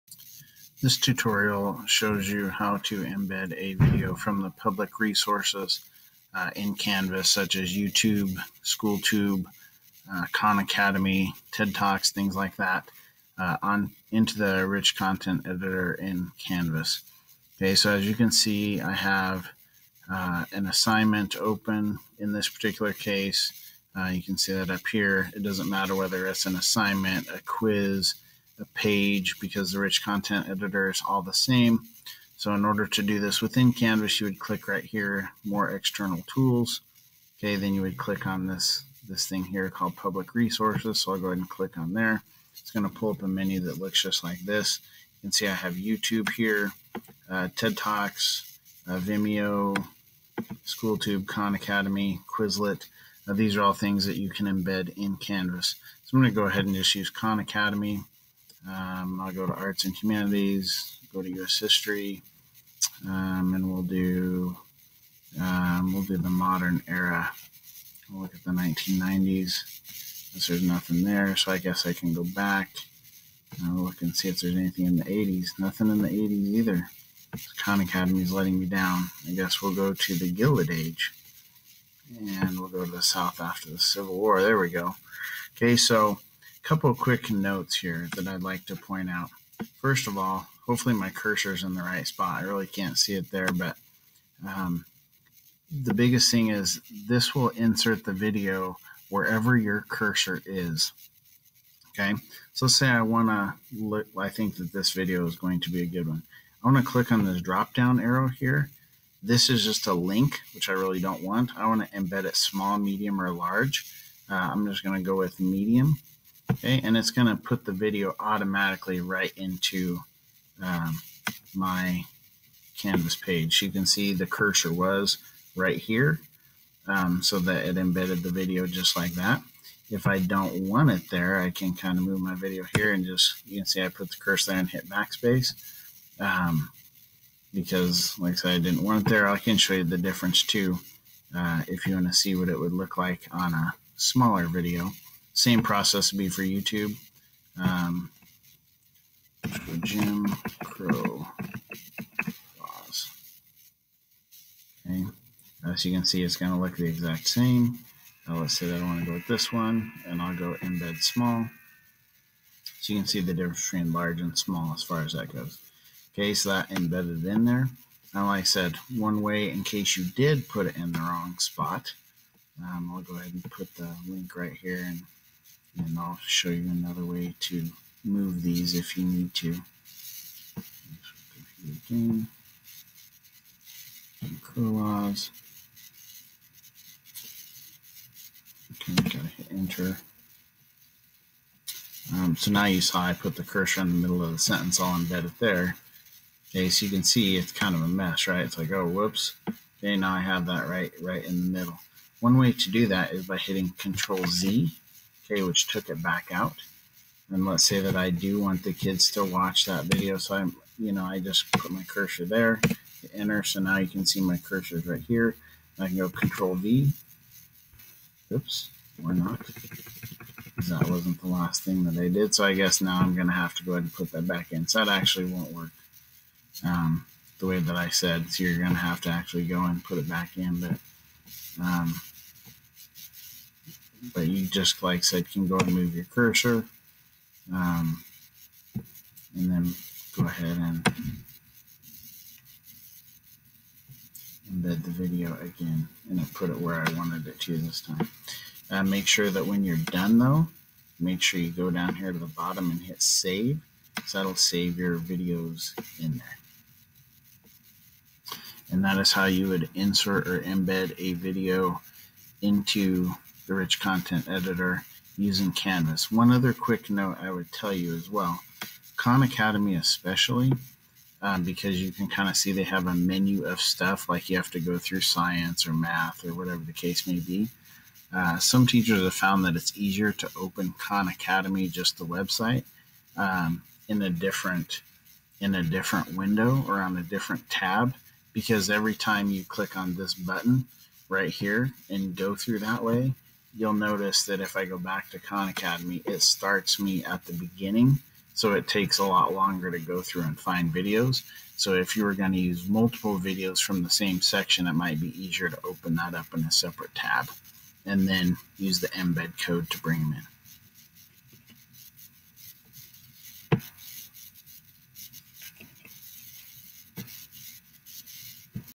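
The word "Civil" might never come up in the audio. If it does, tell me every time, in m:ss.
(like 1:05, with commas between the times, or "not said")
1:23.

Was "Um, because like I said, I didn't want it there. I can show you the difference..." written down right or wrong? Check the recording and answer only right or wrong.
right.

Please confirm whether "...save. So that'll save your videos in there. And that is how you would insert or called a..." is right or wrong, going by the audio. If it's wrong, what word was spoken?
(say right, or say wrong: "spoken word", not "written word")
wrong: "embed", not "called".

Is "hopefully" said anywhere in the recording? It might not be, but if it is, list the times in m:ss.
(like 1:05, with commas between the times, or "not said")
1:30.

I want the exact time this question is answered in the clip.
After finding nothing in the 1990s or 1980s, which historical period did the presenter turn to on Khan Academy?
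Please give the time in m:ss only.
1:20.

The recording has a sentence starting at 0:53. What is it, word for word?
Uh, these are all things that you can embed in Canvas.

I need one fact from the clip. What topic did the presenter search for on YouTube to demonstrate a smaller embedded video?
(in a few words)
Jim Crow laws.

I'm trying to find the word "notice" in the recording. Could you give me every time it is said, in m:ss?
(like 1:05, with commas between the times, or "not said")
4:53.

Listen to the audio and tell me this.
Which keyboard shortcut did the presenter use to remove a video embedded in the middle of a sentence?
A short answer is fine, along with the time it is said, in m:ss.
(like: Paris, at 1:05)
Control Z, at 3:23.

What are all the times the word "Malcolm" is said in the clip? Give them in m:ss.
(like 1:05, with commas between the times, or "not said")
not said.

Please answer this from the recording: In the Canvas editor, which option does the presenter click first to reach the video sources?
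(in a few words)
More external tools.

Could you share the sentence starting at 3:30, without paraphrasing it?
So I'm, you know, I just put my cursor there, enter.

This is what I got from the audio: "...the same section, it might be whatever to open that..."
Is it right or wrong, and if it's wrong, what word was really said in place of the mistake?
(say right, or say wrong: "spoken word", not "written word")
wrong: "easier", not "whatever".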